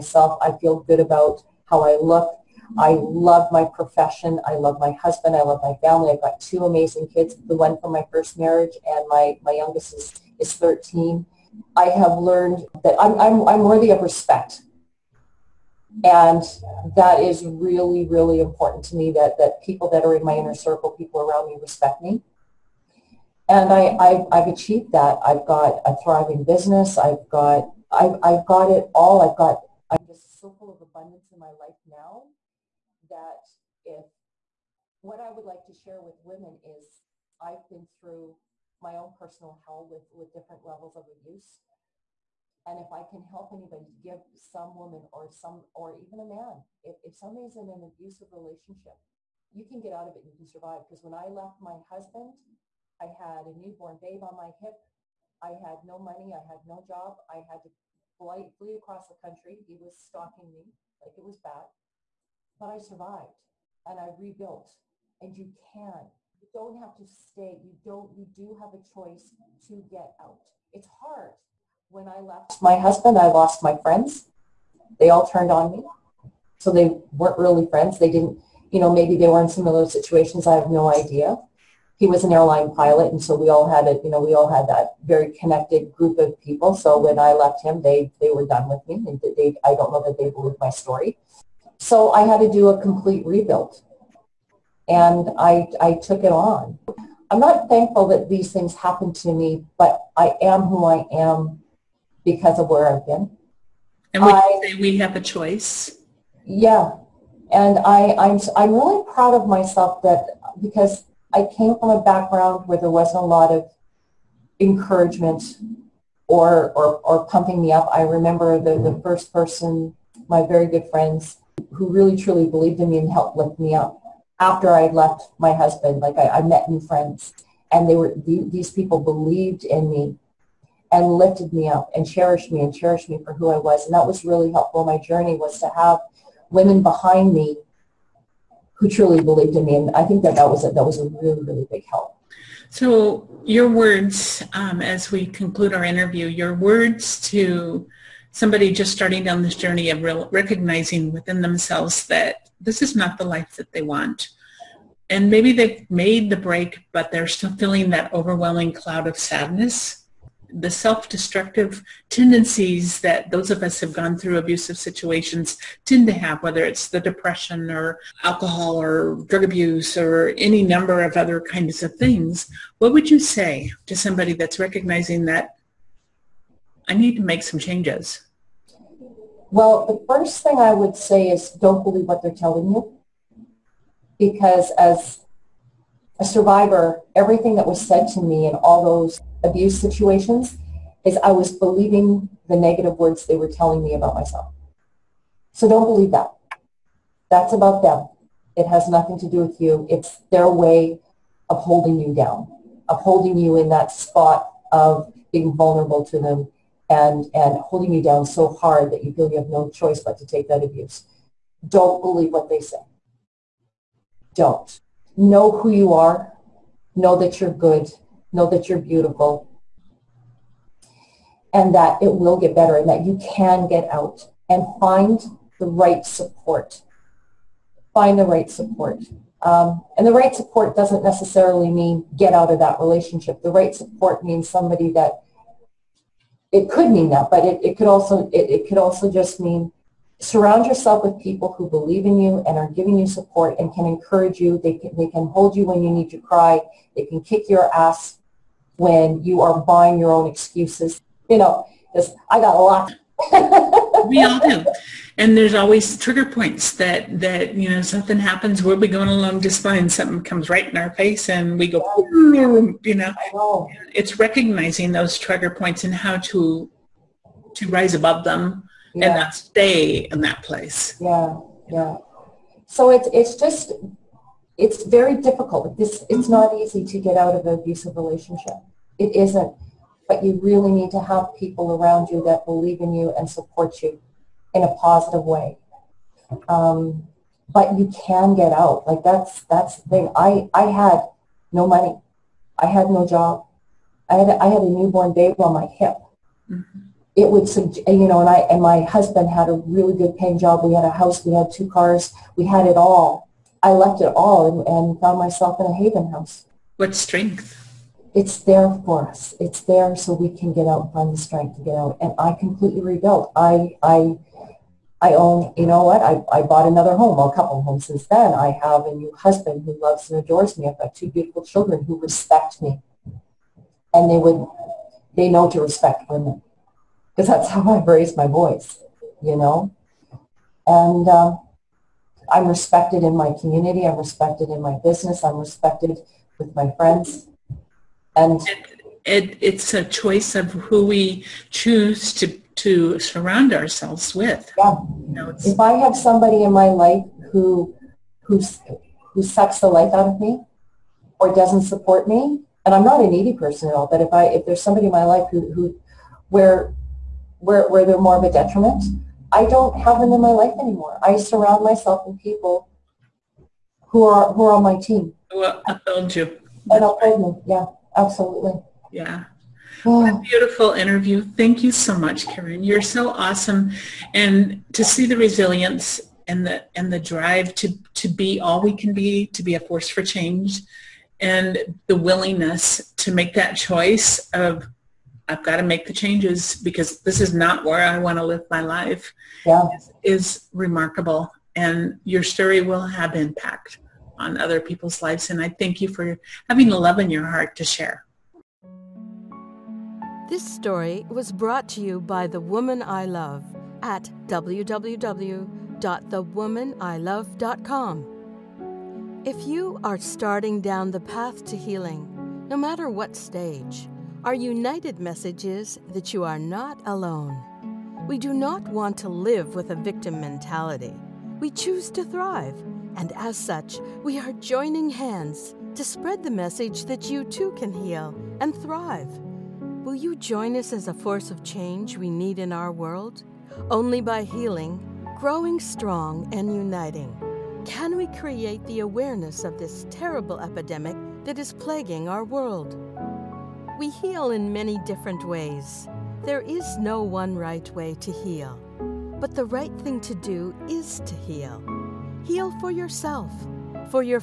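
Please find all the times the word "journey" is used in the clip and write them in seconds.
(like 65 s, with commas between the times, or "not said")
134 s, 149 s.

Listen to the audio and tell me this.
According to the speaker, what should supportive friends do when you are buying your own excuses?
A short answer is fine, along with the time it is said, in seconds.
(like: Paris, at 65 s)
kick your ass, at 247 s.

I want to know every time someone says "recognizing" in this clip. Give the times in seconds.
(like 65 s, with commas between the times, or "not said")
150 s, 174 s, 264 s.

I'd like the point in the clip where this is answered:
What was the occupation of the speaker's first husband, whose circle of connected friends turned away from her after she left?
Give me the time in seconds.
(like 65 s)
82 s.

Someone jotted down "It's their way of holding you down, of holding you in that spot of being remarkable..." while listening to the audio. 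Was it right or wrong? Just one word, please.
wrong.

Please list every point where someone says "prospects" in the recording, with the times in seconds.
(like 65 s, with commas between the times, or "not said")
not said.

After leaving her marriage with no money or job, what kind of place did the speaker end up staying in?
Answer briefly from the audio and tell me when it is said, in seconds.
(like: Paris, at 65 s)
haven house, at 305 s.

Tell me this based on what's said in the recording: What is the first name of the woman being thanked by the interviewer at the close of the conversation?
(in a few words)
Karen.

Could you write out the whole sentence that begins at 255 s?
And there's always trigger points that, that, you know, something happens, we'll be going along just fine.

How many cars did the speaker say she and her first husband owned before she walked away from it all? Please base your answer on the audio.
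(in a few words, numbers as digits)
2.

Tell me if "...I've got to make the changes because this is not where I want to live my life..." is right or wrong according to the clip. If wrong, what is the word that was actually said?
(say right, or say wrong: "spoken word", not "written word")
right.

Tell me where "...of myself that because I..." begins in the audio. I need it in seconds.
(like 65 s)
109 s.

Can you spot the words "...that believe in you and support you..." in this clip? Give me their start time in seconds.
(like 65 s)
282 s.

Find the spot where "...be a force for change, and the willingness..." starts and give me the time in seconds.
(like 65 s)
379 s.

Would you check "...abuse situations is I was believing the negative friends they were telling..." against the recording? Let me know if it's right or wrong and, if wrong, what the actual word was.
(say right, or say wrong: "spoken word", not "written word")
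wrong: "words", not "friends".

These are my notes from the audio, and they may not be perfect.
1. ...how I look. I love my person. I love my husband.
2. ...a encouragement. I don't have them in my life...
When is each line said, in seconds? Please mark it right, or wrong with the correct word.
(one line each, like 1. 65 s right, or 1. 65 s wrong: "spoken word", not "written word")
1. 1 s wrong: "profession", not "person"
2. 358 s wrong: "detriment", not "encouragement".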